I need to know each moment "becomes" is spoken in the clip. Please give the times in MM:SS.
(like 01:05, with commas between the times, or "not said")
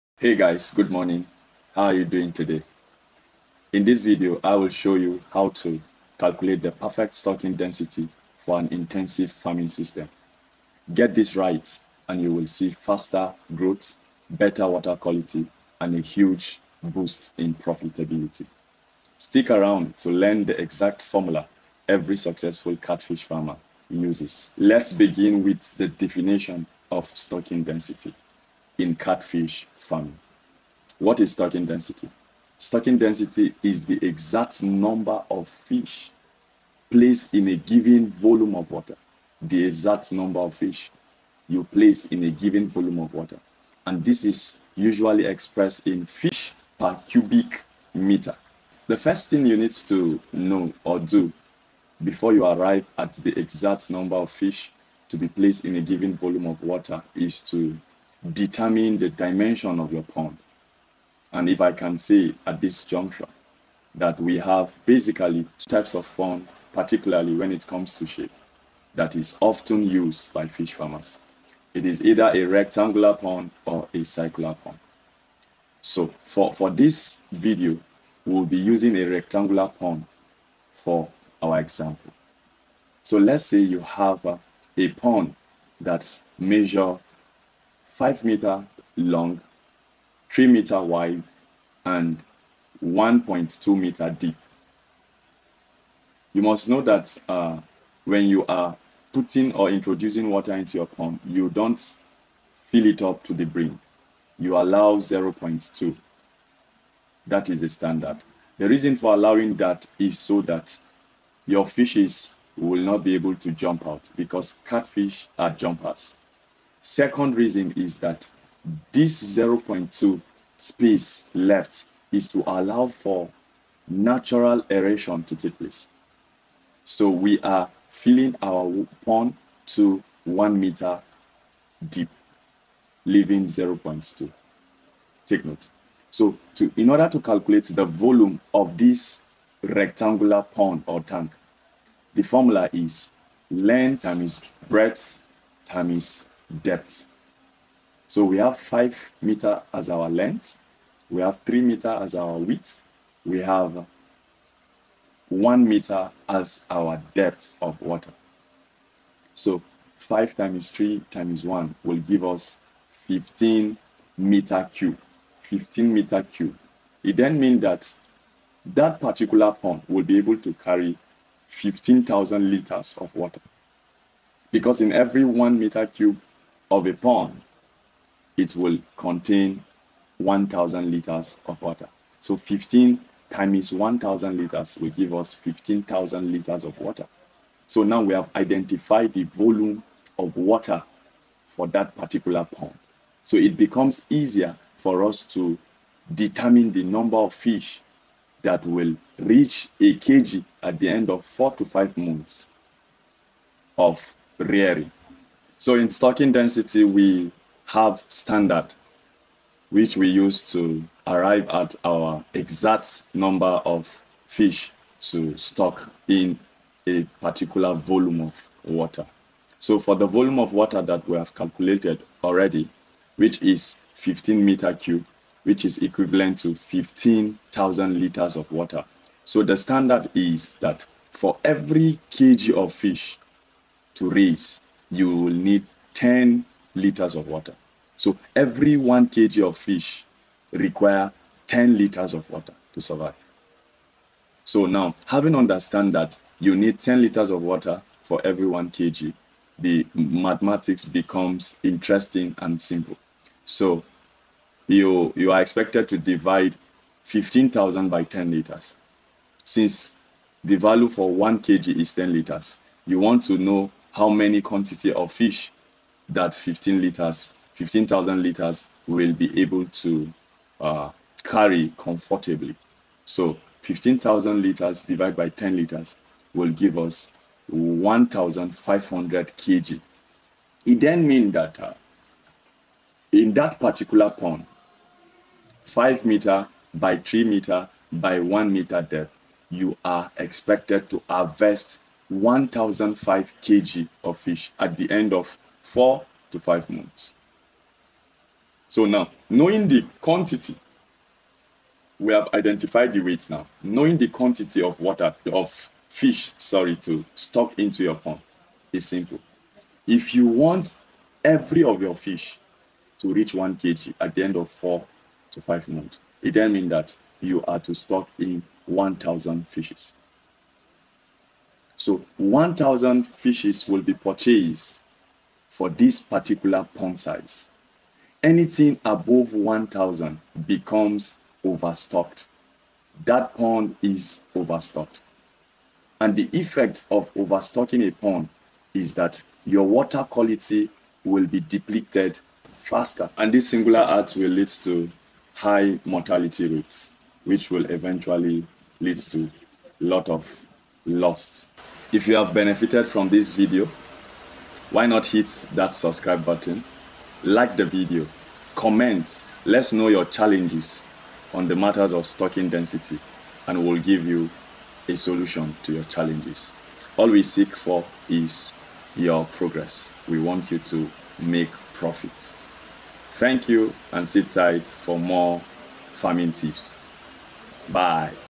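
03:13, 04:10, 05:30.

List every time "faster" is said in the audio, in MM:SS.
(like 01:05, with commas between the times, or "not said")
00:12, 05:42.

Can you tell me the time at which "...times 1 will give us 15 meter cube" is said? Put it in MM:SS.
02:41.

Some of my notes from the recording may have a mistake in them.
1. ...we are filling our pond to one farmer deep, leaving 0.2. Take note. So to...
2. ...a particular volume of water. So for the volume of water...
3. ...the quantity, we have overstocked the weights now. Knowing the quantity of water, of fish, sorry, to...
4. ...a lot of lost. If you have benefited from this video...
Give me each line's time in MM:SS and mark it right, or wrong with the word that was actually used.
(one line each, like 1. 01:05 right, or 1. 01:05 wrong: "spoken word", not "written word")
1. 02:07 wrong: "meter", not "farmer"
2. 03:36 right
3. 04:59 wrong: "identified", not "overstocked"
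4. 05:49 right.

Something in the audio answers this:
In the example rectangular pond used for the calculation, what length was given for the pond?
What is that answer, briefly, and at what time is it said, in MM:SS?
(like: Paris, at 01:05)
5 meters, at 01:28.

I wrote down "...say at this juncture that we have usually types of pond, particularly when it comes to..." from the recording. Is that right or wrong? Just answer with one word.
wrong.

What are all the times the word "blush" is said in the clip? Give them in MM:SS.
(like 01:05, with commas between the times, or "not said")
not said.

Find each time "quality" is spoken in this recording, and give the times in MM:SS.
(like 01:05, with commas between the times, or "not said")
00:14, 05:40.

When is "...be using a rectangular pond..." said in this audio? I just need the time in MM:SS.
01:18.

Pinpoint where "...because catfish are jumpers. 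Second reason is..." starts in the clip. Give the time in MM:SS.
01:54.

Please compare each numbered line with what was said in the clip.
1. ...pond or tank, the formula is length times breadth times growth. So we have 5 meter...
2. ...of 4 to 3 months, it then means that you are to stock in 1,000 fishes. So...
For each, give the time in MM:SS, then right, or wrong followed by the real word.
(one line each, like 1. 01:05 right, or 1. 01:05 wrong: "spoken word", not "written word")
1. 02:20 wrong: "depth", not "growth"
2. 05:14 wrong: "5", not "3".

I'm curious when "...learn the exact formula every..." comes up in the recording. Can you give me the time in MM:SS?
00:20.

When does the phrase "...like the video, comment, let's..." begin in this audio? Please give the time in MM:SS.
05:57.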